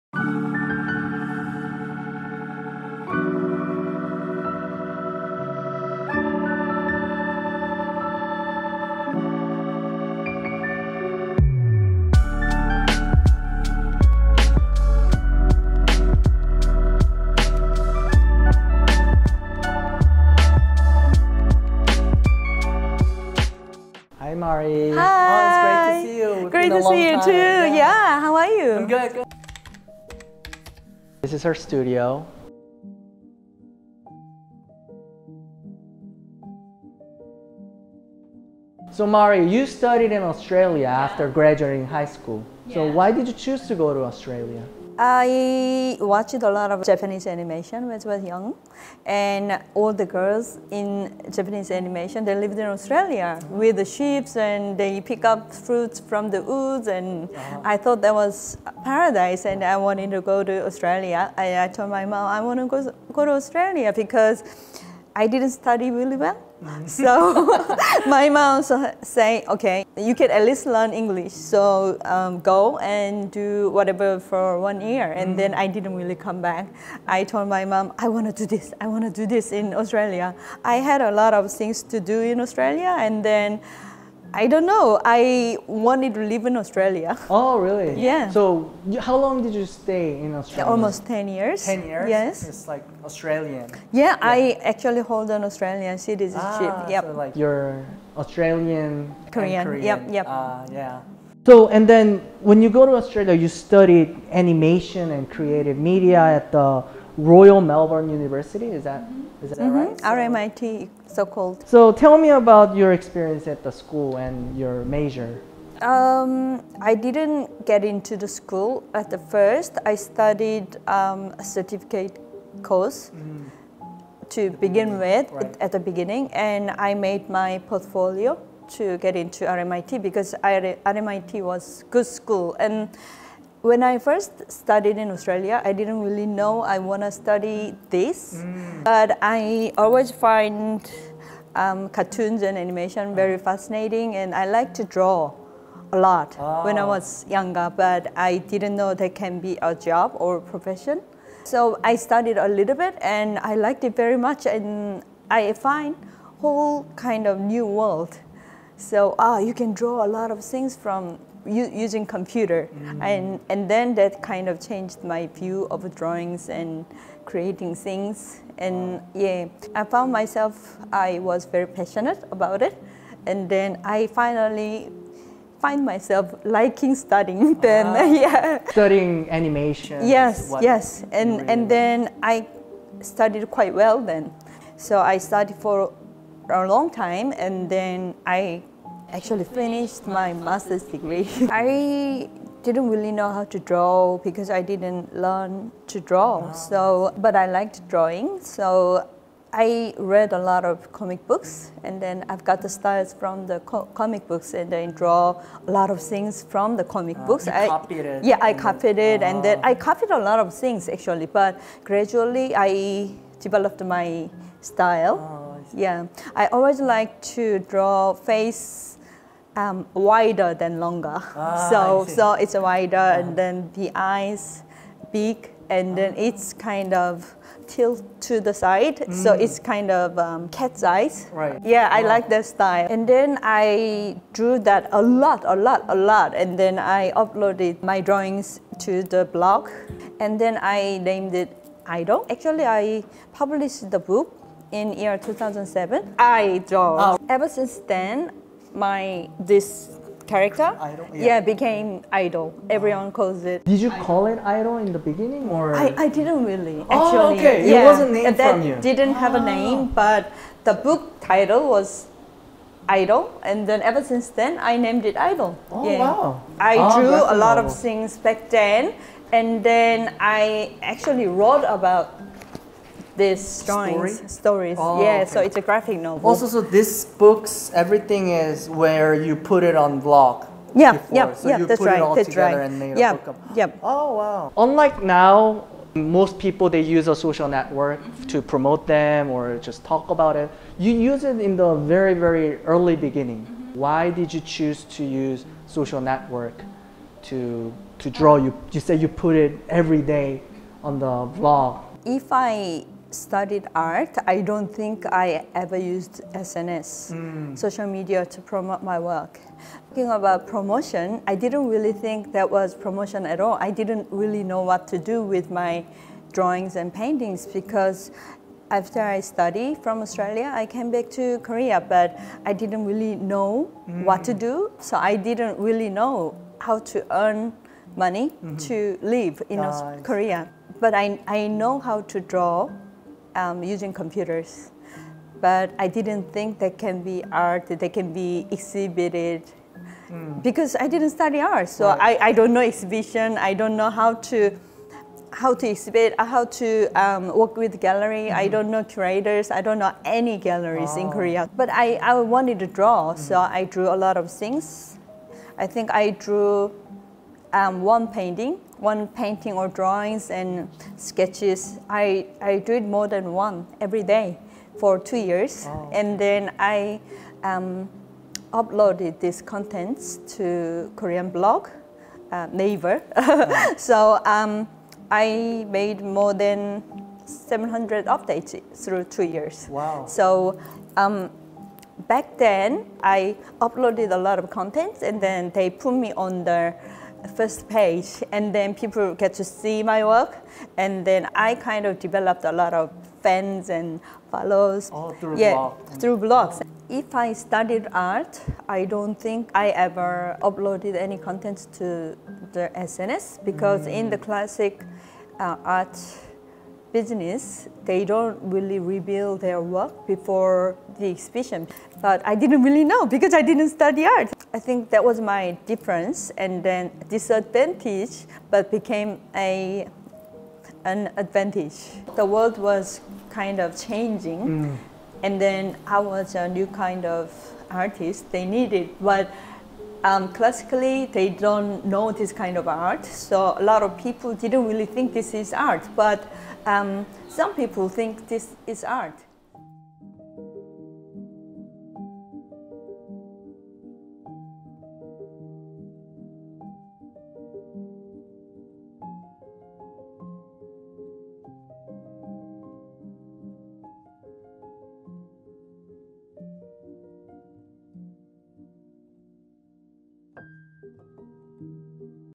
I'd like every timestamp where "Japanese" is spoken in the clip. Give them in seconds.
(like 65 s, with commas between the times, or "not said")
46 s, 51 s.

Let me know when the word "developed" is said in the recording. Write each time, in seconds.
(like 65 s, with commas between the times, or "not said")
213 s, 391 s.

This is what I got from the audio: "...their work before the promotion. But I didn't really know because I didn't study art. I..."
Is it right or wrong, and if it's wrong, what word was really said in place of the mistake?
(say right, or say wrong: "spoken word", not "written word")
wrong: "exhibition", not "promotion".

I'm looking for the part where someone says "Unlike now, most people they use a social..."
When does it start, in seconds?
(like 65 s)
284 s.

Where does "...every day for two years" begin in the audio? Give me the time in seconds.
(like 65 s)
363 s.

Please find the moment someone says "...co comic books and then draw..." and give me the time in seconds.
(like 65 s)
203 s.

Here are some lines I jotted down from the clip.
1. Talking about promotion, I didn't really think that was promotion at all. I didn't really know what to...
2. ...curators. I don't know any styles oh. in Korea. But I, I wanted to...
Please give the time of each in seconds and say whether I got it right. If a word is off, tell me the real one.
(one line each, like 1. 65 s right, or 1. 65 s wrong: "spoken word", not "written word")
1. 309 s right
2. 348 s wrong: "galleries", not "styles".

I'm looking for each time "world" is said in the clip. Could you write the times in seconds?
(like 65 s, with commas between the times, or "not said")
157 s, 422 s.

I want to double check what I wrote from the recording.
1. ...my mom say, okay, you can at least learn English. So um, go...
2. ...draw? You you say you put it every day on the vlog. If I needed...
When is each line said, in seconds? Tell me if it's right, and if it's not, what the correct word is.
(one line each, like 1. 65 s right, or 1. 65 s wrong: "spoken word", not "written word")
1. 68 s right
2. 298 s wrong: "studied", not "needed".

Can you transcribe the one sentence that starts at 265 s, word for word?
wow i oh, drew a lot of things back then and then i actually wrote about this drawings, Story?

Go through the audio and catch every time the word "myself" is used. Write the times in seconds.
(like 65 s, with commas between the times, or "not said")
170 s, 175 s.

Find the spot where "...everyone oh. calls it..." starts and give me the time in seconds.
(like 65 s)
252 s.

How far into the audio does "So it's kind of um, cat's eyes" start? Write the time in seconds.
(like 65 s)
229 s.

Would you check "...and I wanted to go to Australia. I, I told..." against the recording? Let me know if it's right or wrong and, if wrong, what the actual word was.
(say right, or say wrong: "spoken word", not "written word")
right.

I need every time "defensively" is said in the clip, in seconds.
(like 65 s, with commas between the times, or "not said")
not said.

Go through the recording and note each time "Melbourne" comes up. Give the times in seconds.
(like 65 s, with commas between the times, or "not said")
107 s.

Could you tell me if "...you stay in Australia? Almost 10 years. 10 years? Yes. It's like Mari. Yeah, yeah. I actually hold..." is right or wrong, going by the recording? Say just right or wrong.
wrong.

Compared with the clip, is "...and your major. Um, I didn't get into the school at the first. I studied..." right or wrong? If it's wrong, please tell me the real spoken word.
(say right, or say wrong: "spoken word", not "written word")
right.